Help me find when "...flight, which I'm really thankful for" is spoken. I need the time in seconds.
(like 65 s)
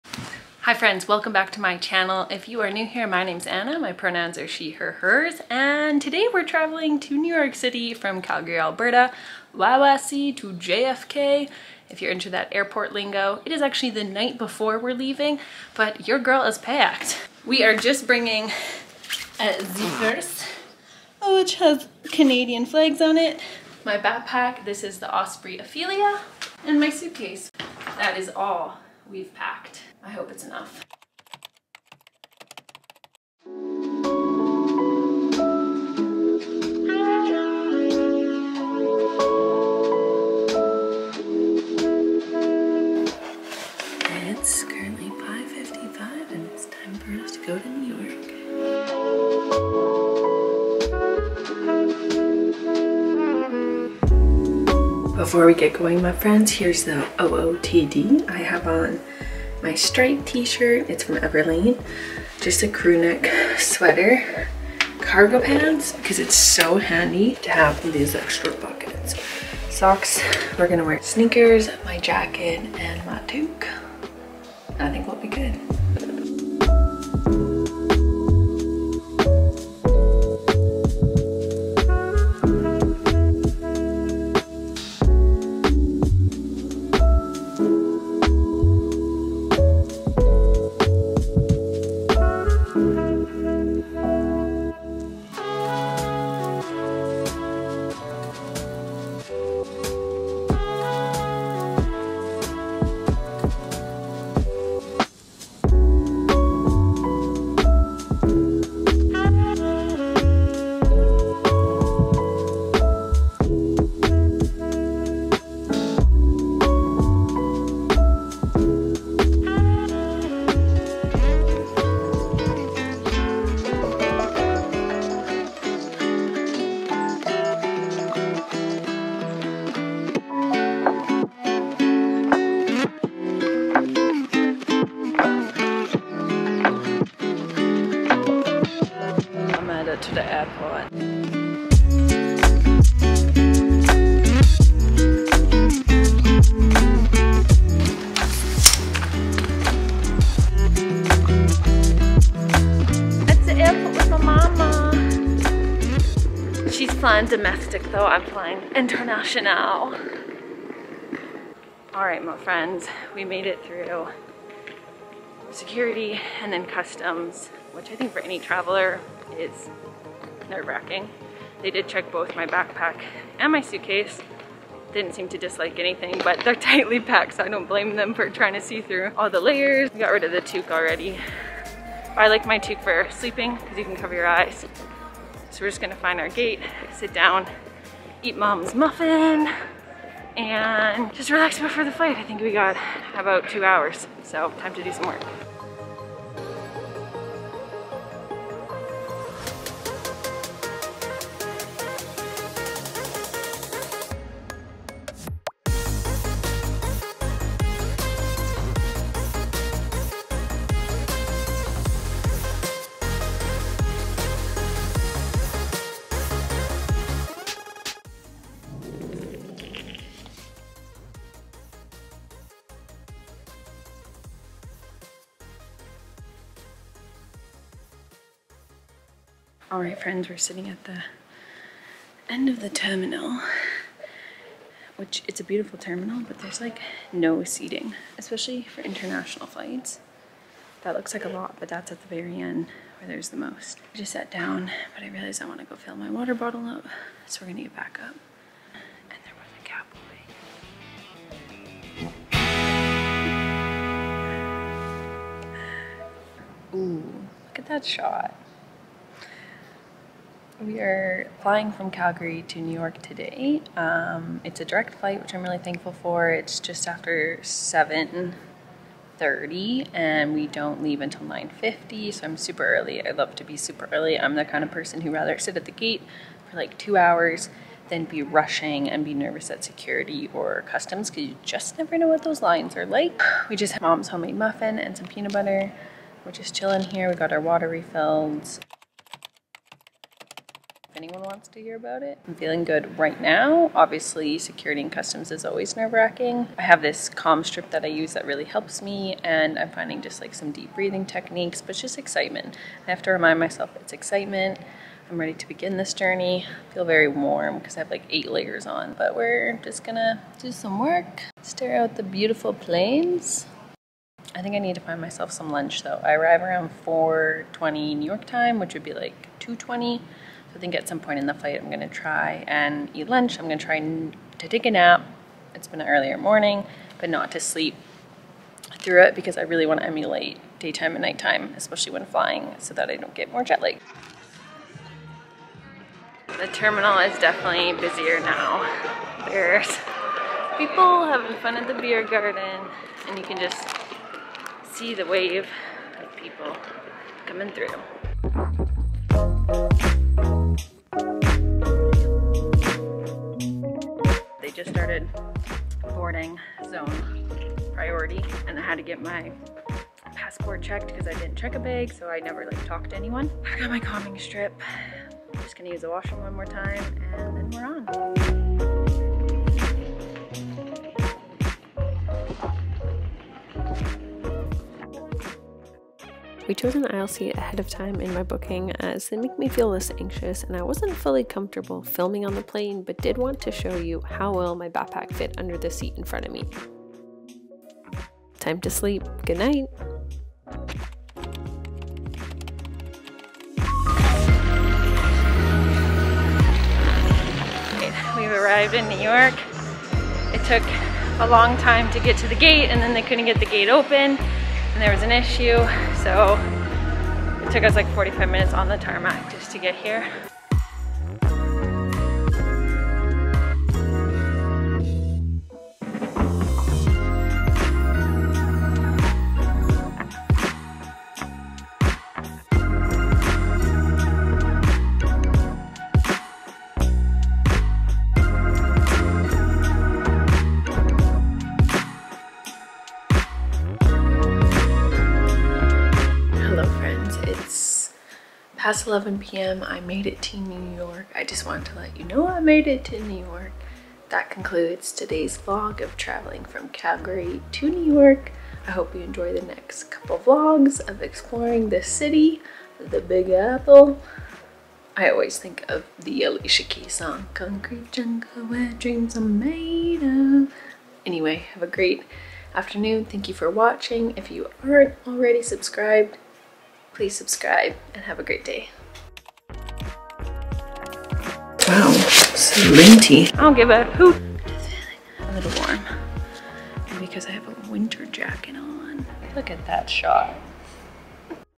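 264 s.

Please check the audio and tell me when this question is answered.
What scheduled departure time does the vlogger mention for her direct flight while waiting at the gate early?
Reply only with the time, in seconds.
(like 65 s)
271 s.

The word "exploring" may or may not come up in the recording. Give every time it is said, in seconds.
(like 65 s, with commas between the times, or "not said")
451 s.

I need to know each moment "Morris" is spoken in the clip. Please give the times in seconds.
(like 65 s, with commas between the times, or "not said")
not said.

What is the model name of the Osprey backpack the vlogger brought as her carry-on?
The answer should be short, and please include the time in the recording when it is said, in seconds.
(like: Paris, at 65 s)
Ophelia, at 25 s.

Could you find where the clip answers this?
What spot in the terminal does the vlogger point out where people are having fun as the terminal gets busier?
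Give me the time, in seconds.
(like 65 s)
341 s.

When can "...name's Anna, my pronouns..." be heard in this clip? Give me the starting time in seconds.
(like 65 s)
3 s.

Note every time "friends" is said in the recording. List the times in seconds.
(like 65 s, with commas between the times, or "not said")
0 s, 56 s, 162 s, 230 s.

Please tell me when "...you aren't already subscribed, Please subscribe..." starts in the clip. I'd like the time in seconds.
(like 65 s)
464 s.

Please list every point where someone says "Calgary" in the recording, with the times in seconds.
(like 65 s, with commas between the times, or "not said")
8 s, 261 s, 446 s.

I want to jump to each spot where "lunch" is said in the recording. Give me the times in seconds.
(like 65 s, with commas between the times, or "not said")
315 s, 323 s.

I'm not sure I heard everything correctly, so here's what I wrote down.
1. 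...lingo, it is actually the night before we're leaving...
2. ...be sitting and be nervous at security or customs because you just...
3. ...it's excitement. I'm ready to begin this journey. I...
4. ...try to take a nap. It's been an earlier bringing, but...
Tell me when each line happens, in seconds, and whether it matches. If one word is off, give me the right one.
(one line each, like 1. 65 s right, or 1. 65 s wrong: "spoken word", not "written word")
1. 12 s right
2. 278 s wrong: "rushing", not "sitting"
3. 303 s right
4. 323 s wrong: "morning", not "bringing".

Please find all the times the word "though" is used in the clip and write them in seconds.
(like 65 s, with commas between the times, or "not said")
157 s, 315 s.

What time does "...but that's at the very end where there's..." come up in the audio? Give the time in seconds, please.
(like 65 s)
241 s.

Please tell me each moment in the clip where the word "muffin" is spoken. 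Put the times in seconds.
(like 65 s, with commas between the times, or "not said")
188 s, 284 s.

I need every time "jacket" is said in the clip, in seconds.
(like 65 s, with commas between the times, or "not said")
71 s, 478 s.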